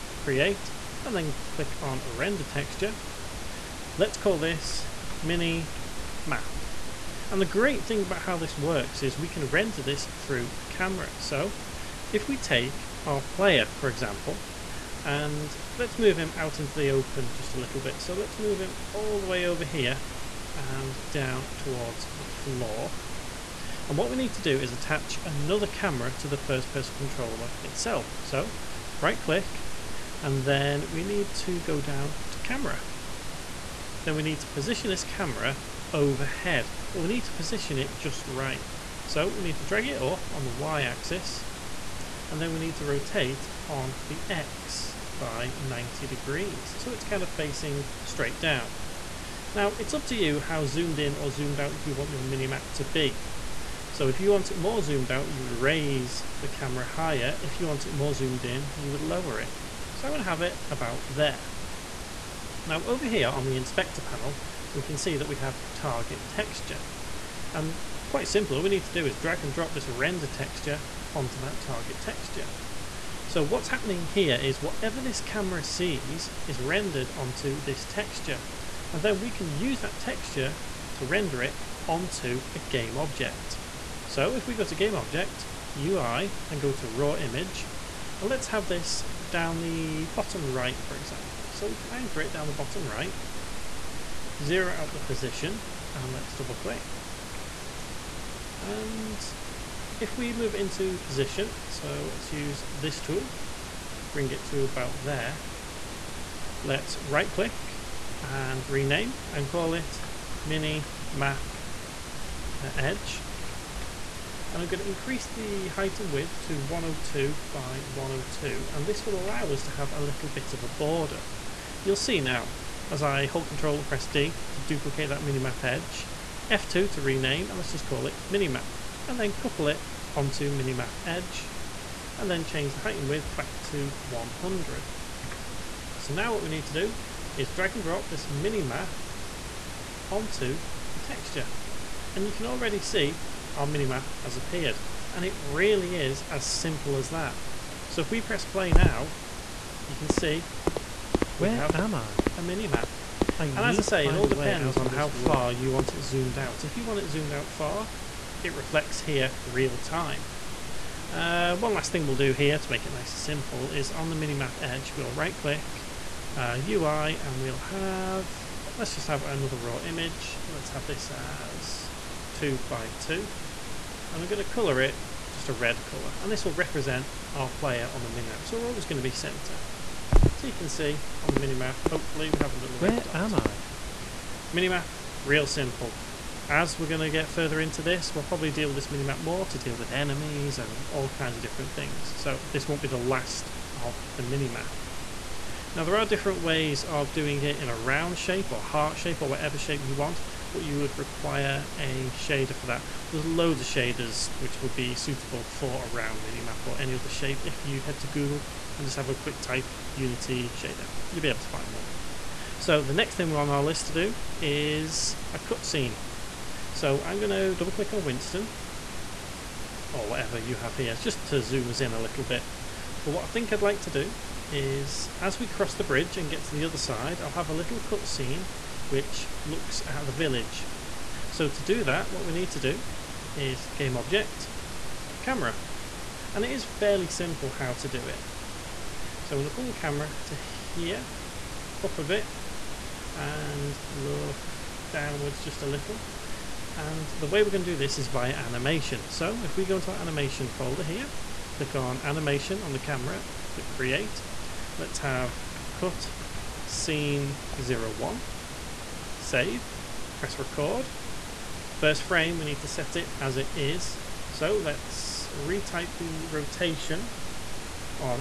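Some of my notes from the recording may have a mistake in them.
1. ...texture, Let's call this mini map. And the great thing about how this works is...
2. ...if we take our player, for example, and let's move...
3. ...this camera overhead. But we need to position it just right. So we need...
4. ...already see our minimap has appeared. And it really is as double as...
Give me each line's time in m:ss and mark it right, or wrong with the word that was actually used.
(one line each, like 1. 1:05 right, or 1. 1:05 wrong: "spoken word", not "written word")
1. 0:02 right
2. 0:12 right
3. 0:34 right
4. 2:22 wrong: "simple", not "double".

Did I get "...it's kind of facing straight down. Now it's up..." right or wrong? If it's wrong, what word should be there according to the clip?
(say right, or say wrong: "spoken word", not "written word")
right.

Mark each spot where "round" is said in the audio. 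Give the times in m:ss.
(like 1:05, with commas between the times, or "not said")
3:17, 3:25.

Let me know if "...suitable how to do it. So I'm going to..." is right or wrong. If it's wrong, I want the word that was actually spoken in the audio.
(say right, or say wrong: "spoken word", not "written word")
wrong: "simple", not "suitable".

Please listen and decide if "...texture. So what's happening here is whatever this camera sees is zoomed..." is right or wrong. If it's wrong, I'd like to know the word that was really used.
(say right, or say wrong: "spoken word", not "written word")
wrong: "rendered", not "zoomed".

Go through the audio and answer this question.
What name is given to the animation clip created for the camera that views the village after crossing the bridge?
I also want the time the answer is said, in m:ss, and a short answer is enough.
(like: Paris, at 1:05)
cut scene 01, at 4:15.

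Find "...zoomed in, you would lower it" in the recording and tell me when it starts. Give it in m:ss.
0:58.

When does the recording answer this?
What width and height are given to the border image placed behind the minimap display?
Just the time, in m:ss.
1:56.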